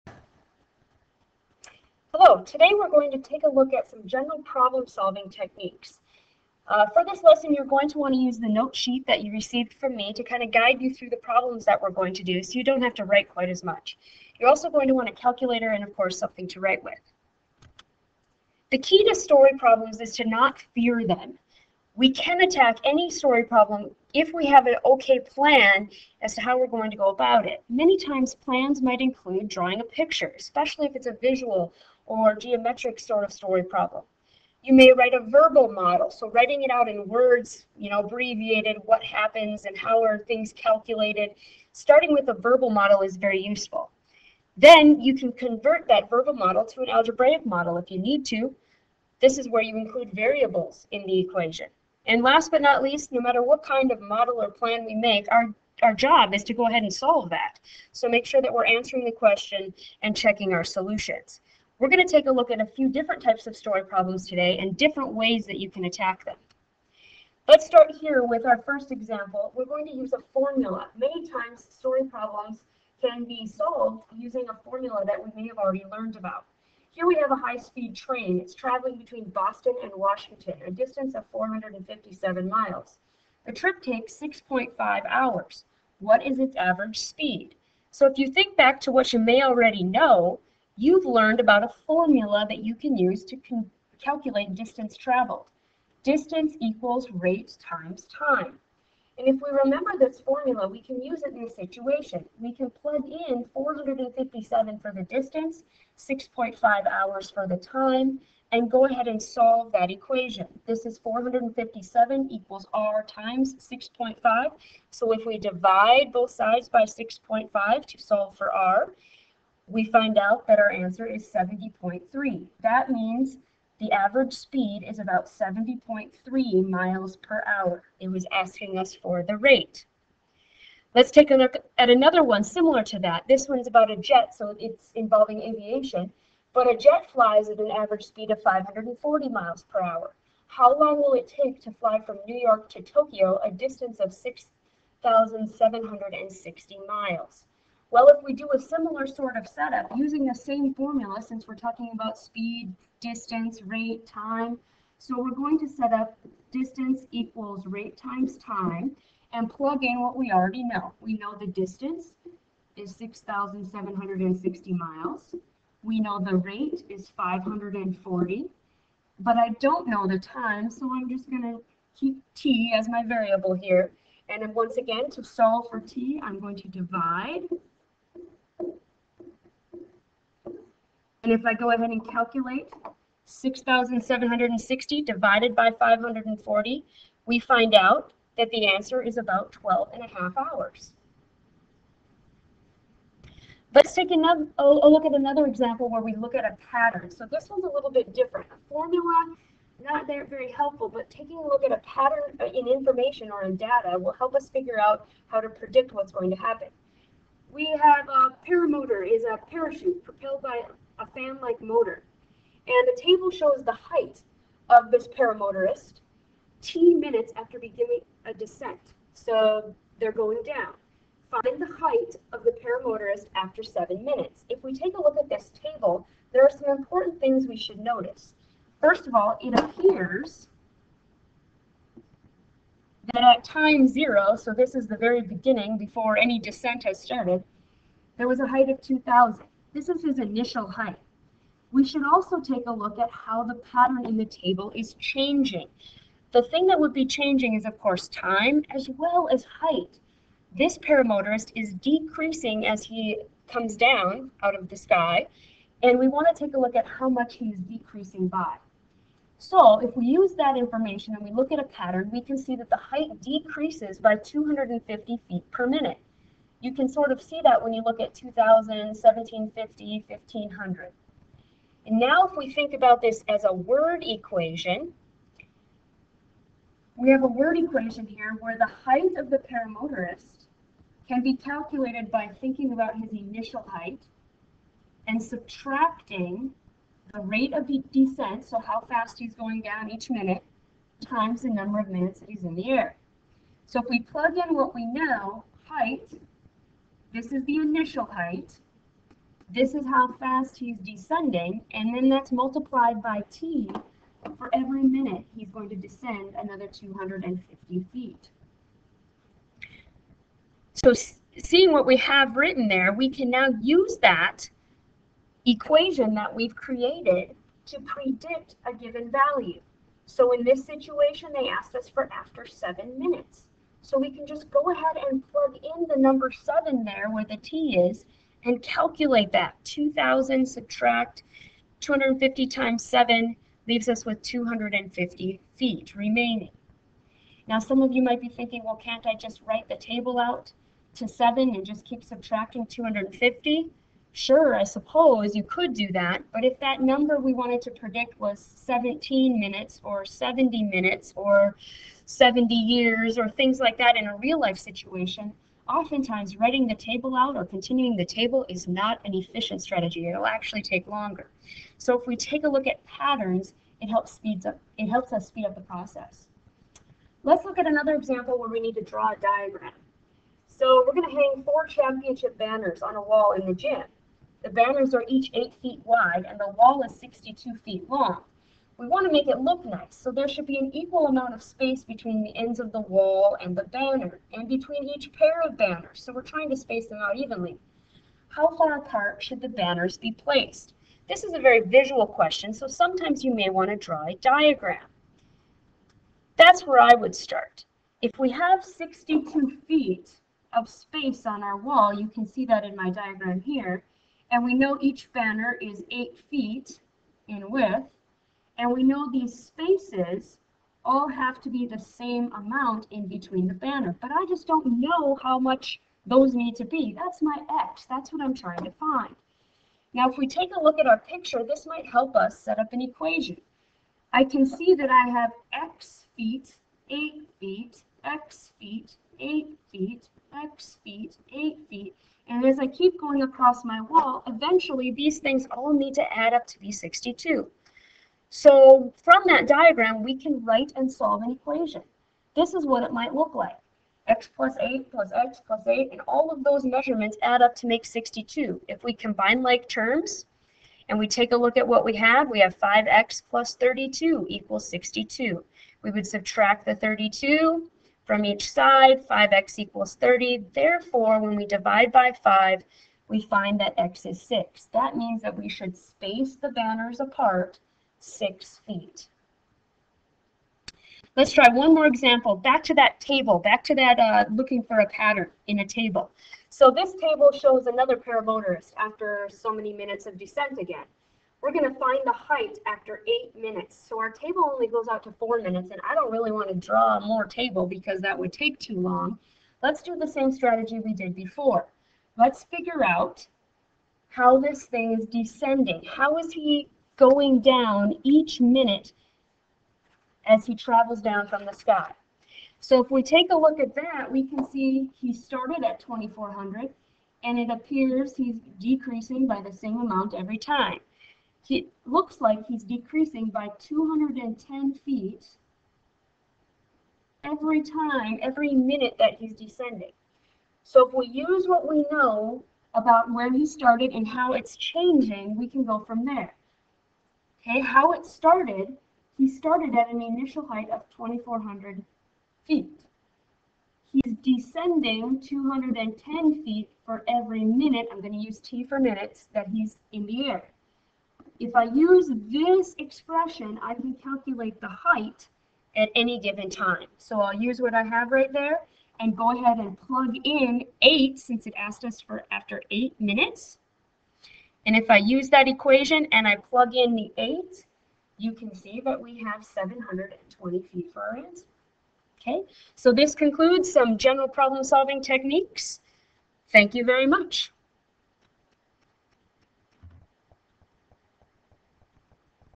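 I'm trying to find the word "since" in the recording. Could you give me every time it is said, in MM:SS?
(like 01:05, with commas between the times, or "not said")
02:31, 09:11.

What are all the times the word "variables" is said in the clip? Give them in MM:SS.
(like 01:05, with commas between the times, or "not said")
00:50, 02:53.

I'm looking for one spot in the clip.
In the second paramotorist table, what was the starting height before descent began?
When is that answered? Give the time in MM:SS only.
08:50.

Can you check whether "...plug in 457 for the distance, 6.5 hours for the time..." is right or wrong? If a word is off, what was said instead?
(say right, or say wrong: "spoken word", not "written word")
right.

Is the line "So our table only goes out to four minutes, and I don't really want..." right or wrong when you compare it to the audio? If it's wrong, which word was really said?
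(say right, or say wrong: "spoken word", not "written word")
right.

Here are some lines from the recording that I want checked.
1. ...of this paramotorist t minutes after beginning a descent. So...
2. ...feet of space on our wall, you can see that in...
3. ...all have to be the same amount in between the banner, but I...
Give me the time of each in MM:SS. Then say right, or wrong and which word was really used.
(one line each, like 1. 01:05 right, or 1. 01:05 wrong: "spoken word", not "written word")
1. 03:34 right
2. 06:39 right
3. 06:50 right.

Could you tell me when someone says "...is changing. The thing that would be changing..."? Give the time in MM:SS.
04:04.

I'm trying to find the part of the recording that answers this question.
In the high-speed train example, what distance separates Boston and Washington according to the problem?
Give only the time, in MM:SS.
01:21.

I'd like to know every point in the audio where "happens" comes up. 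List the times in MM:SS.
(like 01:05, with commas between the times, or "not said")
00:39, 03:26.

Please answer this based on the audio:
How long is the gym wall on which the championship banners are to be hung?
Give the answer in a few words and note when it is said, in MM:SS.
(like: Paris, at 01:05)
62 feet, at 06:16.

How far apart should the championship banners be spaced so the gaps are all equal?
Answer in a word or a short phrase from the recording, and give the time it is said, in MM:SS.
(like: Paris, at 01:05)
6 feet, at 07:48.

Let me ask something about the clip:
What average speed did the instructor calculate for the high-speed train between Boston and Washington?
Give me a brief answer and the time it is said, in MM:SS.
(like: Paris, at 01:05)
70.3 miles per hour, at 02:05.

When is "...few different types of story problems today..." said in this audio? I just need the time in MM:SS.
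01:02.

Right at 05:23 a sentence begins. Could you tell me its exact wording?
So we can just go ahead and plug in the number 7 there where the t is and calculate that.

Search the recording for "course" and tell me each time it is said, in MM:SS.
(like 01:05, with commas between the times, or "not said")
00:15, 04:07.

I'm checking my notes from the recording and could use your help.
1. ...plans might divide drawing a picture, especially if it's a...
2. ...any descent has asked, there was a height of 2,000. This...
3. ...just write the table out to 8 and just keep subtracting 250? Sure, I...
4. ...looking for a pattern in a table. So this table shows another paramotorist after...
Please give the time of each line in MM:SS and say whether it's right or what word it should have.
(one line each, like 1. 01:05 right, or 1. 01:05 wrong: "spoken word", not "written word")
1. 00:28 wrong: "include", not "divide"
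2. 03:56 wrong: "started", not "asked"
3. 05:39 wrong: "7", not "8"
4. 07:54 right.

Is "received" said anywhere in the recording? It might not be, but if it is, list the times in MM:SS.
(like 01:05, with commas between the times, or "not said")
00:09.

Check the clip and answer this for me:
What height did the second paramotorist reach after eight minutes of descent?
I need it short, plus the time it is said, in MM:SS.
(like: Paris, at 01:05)
720 feet, at 09:19.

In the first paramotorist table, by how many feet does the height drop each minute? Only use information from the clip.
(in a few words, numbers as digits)
250 feet.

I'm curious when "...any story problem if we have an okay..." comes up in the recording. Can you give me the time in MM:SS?
00:22.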